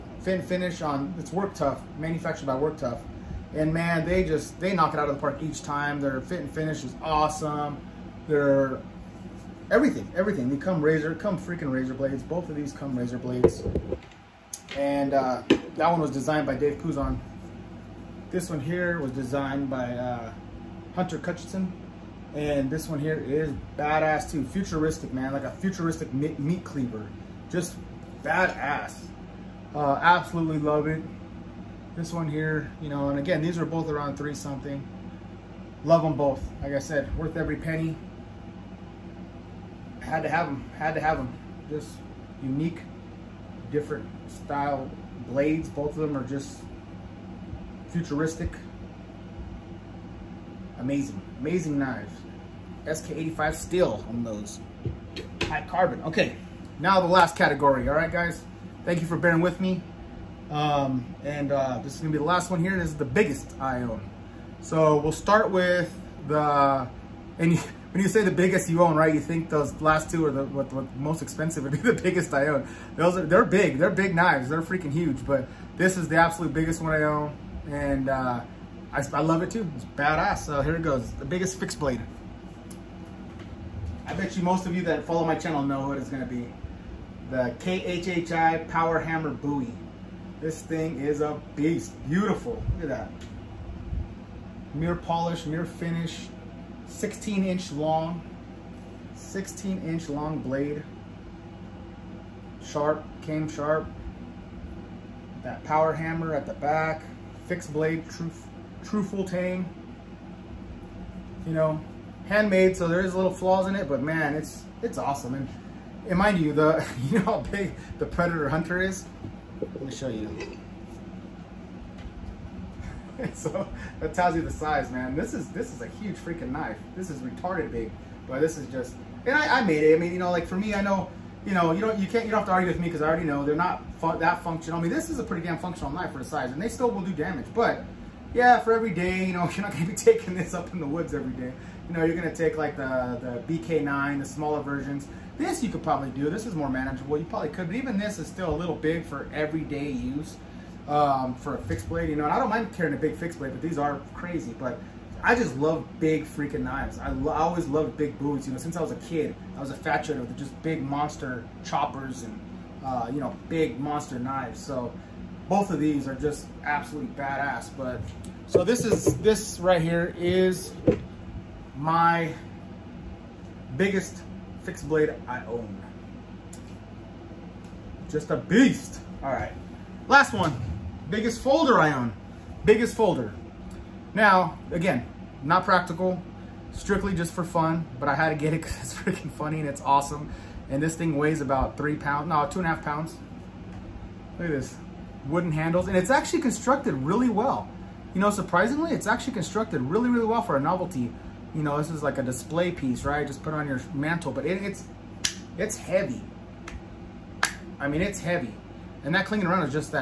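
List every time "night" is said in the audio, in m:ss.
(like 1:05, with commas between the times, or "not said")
not said.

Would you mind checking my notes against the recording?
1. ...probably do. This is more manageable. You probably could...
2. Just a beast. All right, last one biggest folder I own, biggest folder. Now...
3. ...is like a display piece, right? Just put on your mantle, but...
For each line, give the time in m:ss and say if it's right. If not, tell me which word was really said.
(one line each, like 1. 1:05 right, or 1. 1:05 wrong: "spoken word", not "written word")
1. 2:25 right
2. 2:58 right
3. 3:21 right.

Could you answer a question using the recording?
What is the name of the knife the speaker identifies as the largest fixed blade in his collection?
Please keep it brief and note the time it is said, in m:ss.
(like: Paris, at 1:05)
KHHI Power Hammer Bowie, at 1:27.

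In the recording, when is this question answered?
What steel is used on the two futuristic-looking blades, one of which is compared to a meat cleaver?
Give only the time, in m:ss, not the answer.
0:52.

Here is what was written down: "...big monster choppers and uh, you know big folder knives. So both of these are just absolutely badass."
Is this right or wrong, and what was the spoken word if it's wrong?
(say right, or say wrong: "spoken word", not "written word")
wrong: "monster", not "folder".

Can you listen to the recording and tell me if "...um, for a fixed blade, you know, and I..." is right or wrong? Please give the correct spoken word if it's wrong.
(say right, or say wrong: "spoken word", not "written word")
right.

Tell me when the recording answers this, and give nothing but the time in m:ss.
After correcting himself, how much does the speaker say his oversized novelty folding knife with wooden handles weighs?
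3:12.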